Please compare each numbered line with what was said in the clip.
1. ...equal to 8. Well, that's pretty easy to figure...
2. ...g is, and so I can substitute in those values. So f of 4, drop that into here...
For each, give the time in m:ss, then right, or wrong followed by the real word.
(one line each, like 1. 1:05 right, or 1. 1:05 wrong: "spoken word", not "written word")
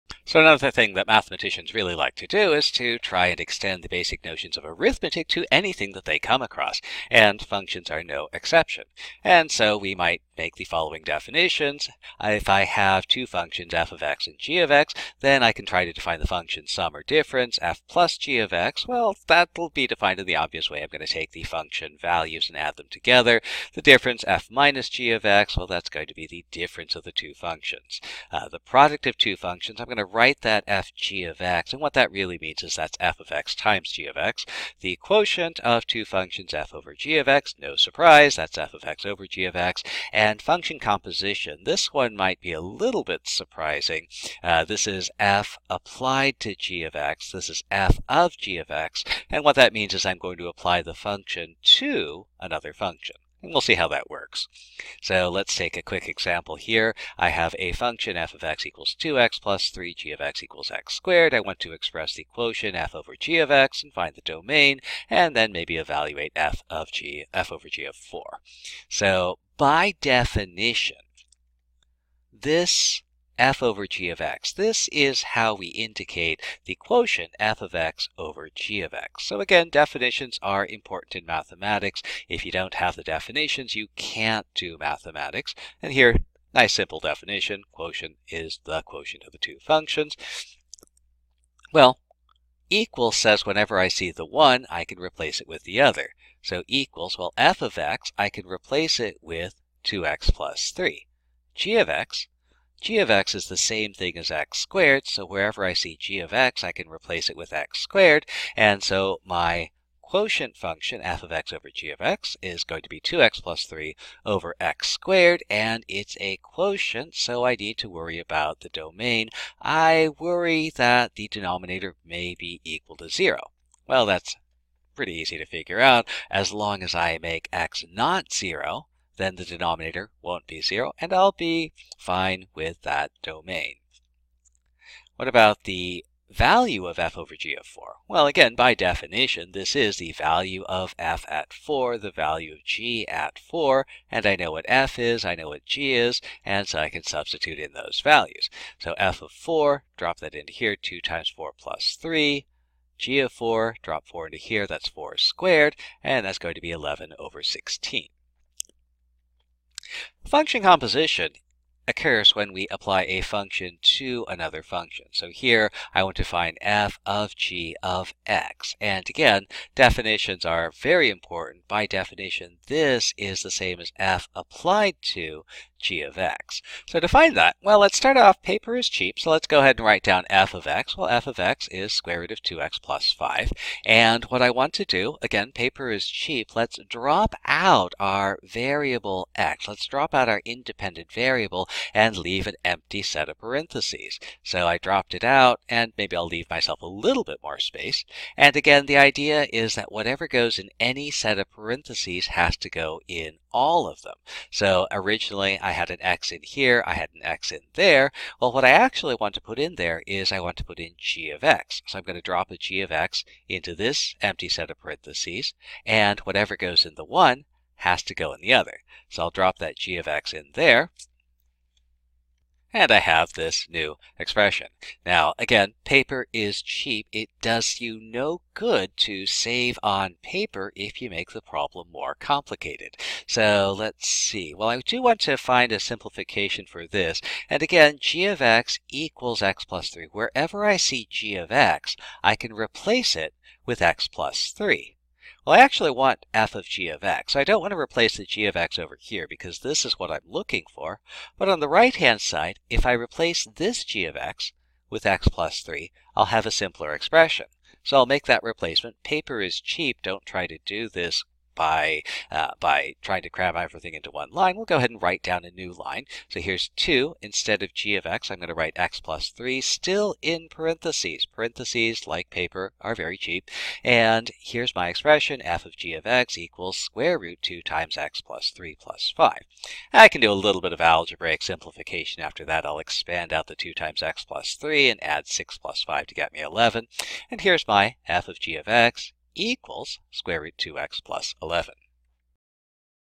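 1. 2:02 wrong: "0", not "8"
2. 2:25 right.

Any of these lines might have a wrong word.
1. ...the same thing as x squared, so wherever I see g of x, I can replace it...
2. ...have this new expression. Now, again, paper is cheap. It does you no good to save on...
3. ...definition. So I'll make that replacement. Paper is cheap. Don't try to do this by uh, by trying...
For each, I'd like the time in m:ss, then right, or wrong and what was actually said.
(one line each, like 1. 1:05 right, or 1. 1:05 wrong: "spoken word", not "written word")
1. 1:43 right
2. 3:42 right
3. 4:16 wrong: "expression", not "definition".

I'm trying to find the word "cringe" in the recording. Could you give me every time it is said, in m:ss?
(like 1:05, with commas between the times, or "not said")
not said.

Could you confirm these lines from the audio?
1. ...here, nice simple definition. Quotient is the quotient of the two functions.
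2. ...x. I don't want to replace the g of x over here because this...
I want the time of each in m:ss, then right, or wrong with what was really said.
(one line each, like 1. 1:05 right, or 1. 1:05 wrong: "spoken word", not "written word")
1. 1:25 right
2. 4:07 right.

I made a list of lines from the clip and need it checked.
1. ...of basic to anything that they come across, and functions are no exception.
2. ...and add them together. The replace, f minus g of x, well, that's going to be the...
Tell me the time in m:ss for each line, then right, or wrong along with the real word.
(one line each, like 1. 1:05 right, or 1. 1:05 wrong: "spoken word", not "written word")
1. 0:04 wrong: "arithmetic", not "basic"
2. 0:22 wrong: "difference", not "replace".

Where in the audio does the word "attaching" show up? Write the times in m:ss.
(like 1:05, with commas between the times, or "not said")
not said.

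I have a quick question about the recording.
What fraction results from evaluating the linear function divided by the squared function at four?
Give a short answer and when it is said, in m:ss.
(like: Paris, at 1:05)
11/16, at 2:36.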